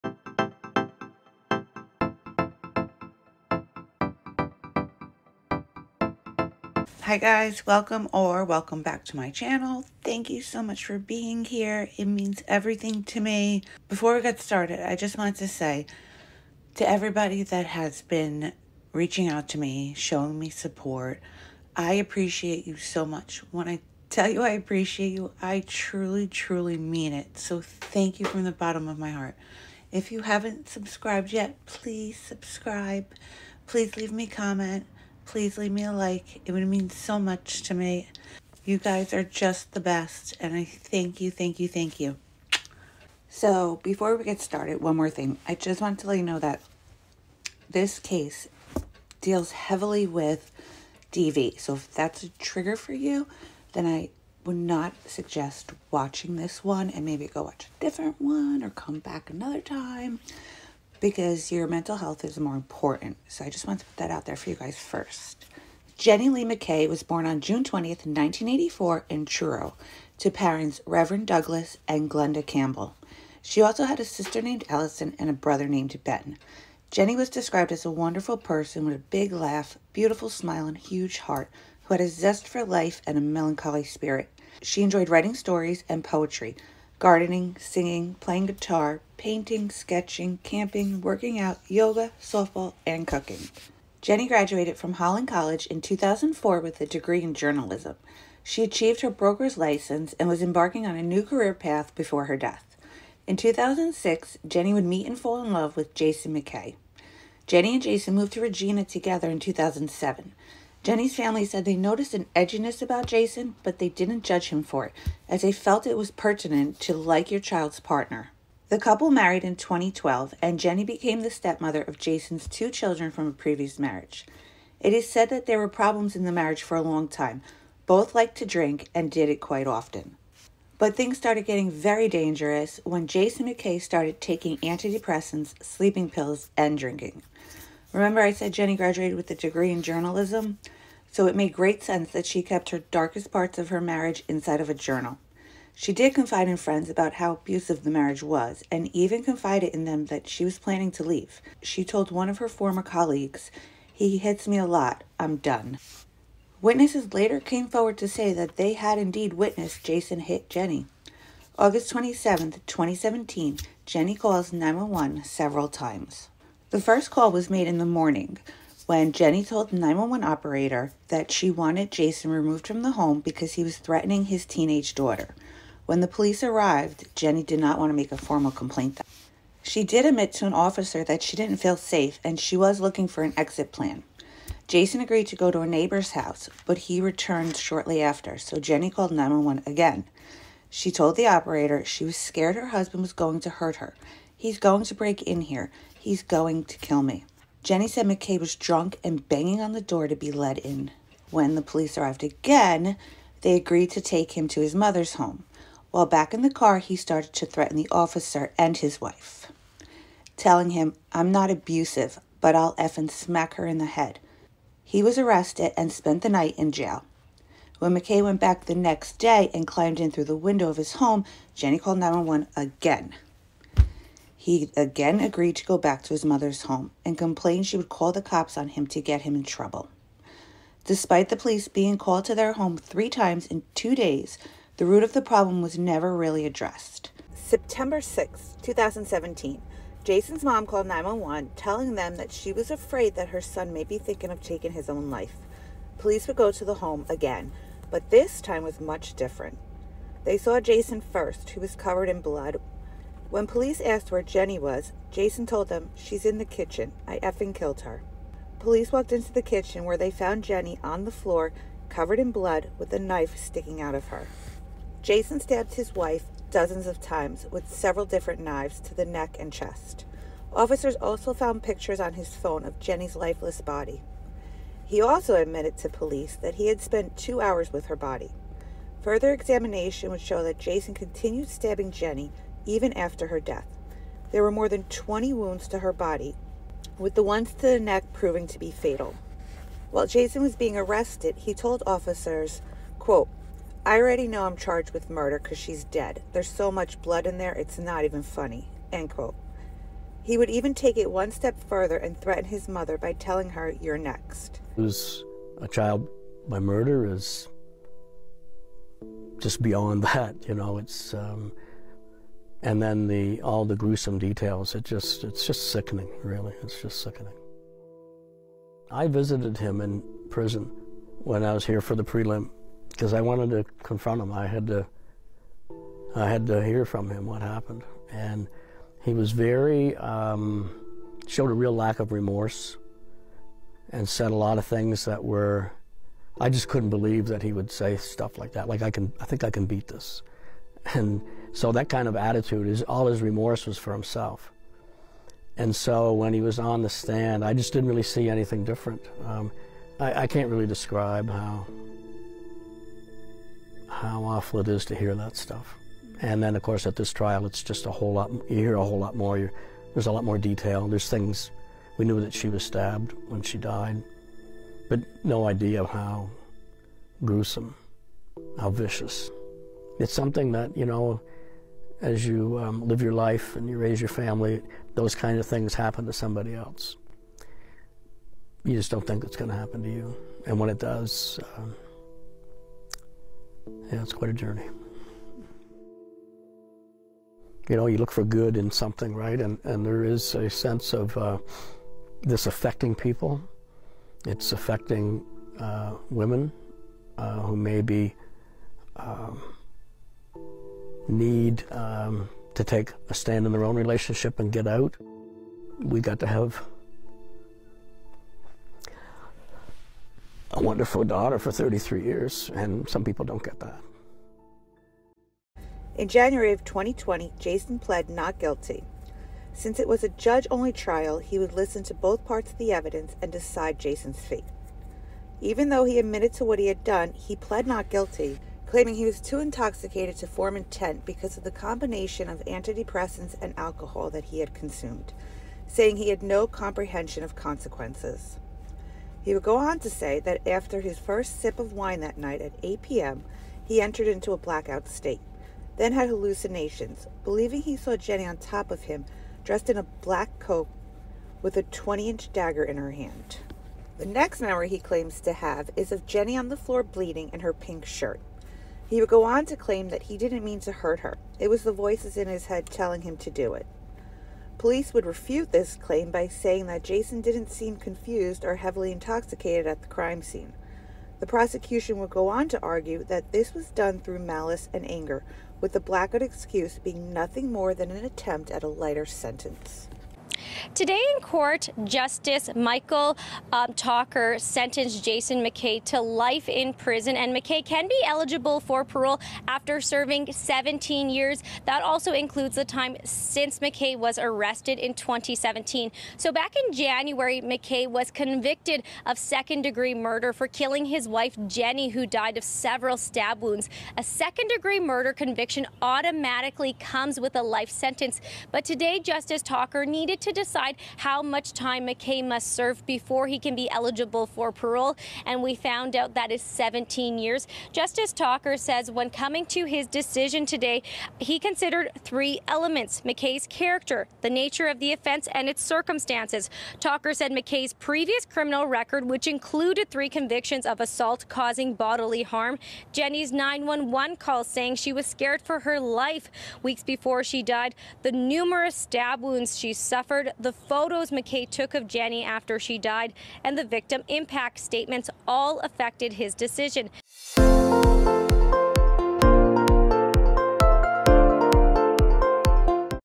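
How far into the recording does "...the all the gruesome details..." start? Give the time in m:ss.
5:13.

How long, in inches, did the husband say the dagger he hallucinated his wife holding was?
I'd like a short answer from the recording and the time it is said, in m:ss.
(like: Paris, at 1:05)
20 inch, at 7:31.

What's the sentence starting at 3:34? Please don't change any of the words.
He was arrested and spent the night in jail.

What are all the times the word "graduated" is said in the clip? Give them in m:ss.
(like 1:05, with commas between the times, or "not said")
1:34, 2:18.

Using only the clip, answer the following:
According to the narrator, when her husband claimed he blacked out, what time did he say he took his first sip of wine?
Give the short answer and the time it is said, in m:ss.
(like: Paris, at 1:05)
8 p.m., at 7:22.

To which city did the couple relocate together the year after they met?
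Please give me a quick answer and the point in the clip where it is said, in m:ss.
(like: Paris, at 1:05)
Regina, at 1:48.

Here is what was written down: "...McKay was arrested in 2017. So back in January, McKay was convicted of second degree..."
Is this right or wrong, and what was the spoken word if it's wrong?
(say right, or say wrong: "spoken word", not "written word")
right.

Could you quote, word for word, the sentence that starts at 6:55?
In January of 2020, Jason pled not guilty.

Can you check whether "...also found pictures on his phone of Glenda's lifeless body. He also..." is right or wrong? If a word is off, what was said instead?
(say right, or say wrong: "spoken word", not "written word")
wrong: "Jenny", not "Glenda".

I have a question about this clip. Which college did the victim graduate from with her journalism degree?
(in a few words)
Holland College.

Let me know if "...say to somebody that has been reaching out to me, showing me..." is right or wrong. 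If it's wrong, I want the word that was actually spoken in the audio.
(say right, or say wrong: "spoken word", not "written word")
wrong: "everybody", not "somebody".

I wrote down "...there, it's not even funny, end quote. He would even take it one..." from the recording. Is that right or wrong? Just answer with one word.
right.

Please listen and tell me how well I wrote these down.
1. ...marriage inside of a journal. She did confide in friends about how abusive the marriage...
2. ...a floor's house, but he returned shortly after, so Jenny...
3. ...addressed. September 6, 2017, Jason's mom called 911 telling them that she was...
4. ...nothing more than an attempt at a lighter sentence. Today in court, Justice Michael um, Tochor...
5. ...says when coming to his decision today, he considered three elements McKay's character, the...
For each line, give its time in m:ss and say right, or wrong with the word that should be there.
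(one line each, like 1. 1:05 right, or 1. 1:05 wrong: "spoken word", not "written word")
1. 2:23 right
2. 3:05 wrong: "neighbor", not "floor"
3. 3:56 right
4. 7:57 right
5. 8:38 right.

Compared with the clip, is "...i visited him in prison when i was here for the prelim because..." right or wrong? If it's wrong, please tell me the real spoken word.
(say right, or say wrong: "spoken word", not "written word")
right.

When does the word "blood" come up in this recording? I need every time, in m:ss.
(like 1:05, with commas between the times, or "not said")
4:12, 4:22, 4:57.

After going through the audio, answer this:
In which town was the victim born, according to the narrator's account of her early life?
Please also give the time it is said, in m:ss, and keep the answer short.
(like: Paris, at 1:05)
Truro, at 1:09.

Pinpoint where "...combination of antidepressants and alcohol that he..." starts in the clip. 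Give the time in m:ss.
7:11.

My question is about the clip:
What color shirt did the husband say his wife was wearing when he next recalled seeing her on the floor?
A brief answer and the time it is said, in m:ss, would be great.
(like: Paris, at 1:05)
Pink, at 7:37.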